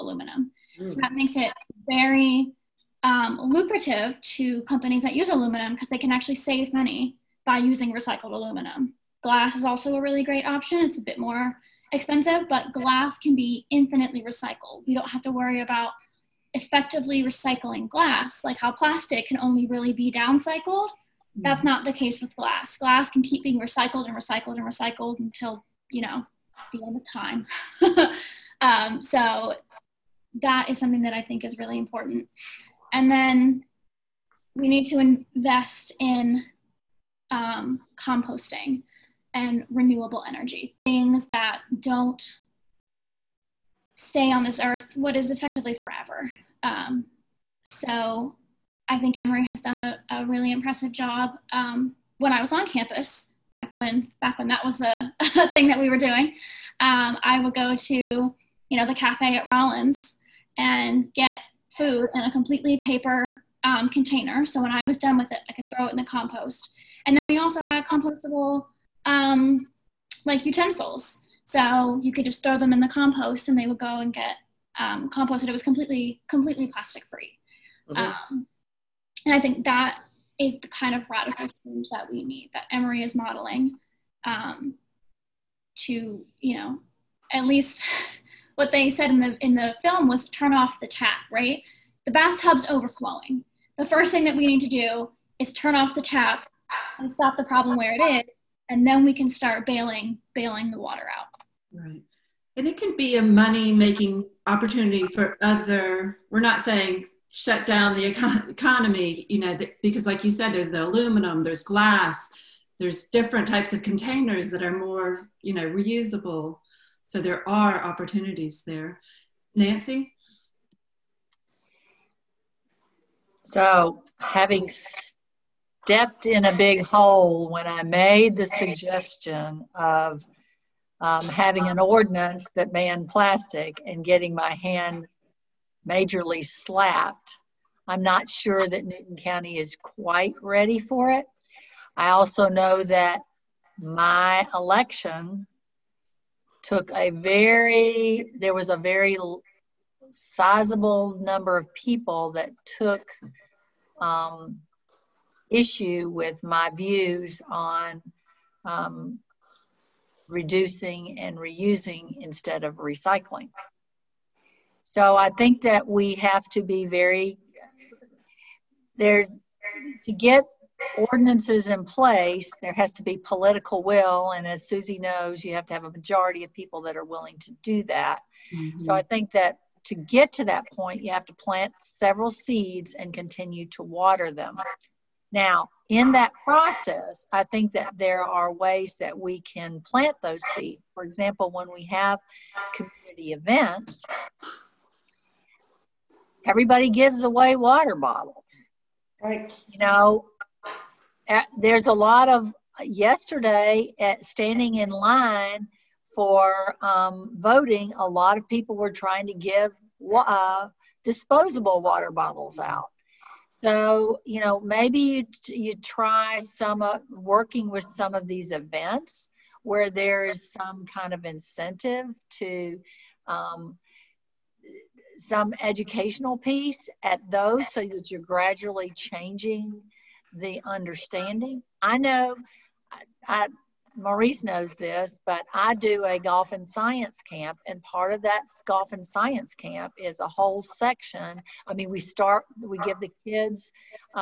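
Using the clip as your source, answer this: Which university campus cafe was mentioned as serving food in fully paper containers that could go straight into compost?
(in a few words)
Rollins.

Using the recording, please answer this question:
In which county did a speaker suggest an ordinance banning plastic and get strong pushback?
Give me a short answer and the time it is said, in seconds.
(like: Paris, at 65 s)
Newton County, at 138 s.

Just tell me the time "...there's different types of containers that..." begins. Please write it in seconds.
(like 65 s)
112 s.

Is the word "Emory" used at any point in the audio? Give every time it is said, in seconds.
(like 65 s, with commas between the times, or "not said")
49 s, 82 s.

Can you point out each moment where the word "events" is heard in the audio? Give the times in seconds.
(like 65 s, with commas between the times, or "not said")
193 s, 218 s.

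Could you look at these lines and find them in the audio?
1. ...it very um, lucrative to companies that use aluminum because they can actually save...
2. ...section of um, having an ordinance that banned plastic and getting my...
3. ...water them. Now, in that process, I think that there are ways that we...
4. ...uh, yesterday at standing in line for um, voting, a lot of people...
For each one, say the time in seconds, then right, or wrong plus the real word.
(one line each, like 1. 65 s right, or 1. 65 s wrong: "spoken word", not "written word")
1. 1 s right
2. 128 s wrong: "suggestion", not "section"
3. 183 s right
4. 202 s right.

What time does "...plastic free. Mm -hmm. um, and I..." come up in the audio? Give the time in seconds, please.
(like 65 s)
76 s.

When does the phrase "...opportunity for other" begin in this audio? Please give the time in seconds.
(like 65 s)
104 s.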